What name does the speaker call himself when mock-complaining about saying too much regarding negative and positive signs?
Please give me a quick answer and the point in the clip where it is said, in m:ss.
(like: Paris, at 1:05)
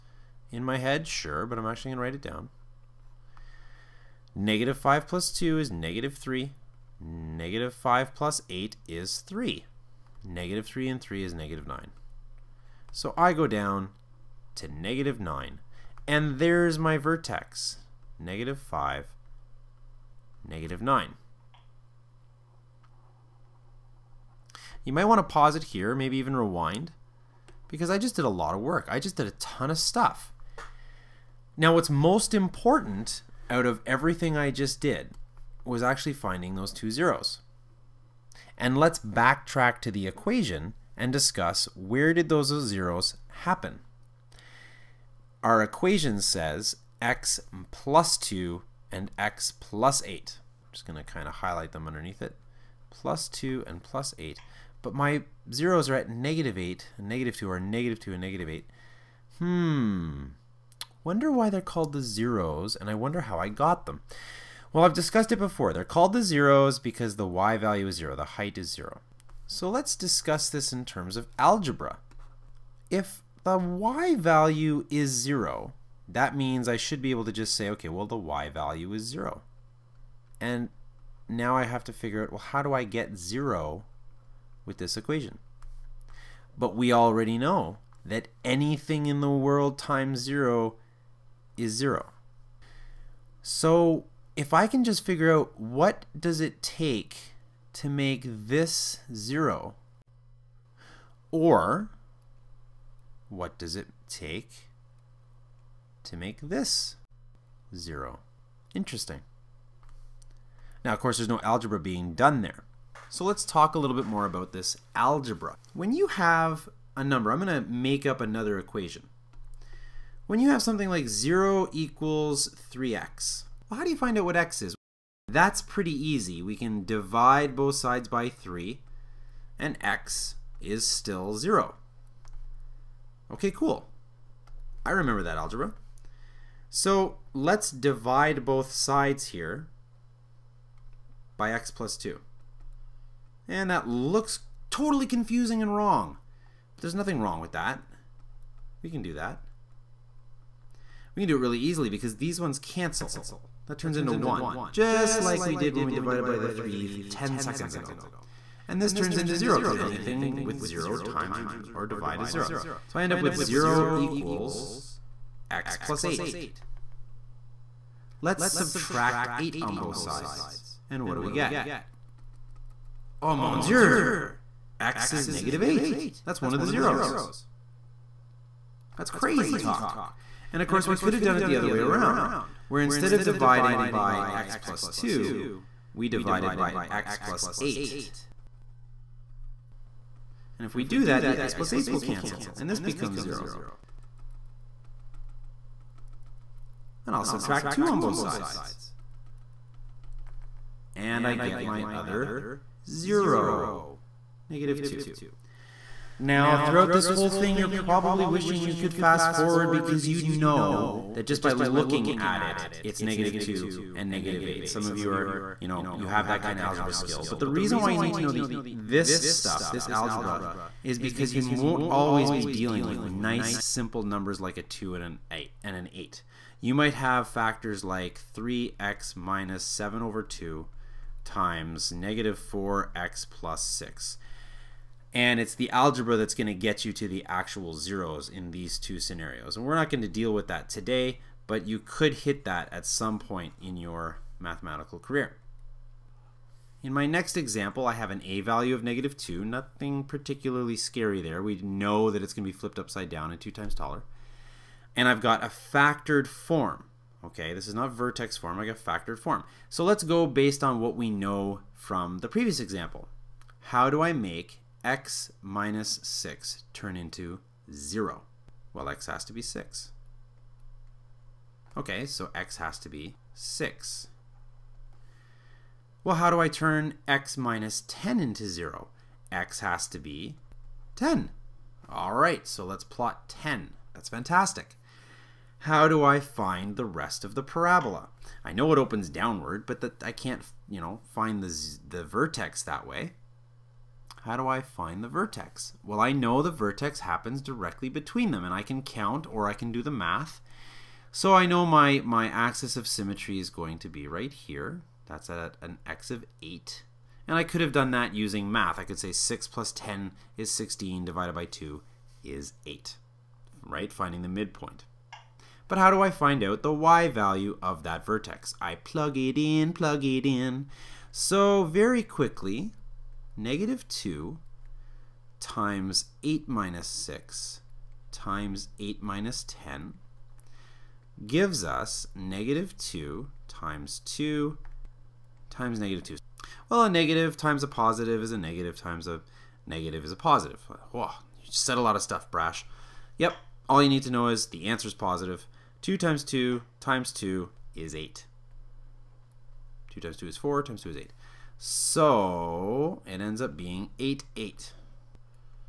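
Brash, at 5:42.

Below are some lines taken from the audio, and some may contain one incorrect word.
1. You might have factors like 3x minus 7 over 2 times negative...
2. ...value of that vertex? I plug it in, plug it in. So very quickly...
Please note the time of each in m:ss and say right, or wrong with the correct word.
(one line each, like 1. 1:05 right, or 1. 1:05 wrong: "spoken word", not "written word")
1. 3:46 right
2. 5:17 right.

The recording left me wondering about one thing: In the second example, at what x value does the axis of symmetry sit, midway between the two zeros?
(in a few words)
8.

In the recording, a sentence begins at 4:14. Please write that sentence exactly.
And I've got a factored form.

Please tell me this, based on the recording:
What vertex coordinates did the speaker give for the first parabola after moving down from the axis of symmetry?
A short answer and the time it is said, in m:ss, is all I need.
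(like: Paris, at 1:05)
(-5, -9), at 0:18.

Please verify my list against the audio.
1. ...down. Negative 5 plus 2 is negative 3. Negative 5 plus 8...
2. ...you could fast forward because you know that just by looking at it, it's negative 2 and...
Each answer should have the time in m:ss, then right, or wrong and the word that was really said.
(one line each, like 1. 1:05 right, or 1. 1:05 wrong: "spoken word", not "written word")
1. 0:02 right
2. 3:28 right.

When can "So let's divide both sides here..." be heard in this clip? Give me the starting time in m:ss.
2:16.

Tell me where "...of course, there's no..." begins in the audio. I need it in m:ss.
1:50.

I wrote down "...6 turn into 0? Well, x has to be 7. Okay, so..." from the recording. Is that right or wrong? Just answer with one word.
wrong.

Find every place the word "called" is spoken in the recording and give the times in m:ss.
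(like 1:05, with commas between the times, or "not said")
1:01, 1:05.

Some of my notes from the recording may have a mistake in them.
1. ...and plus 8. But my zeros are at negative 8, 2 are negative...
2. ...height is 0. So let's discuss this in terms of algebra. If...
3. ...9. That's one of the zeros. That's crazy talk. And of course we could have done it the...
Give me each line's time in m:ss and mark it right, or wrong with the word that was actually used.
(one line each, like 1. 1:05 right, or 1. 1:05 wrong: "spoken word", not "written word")
1. 0:53 right
2. 1:08 right
3. 2:55 wrong: "8", not "9".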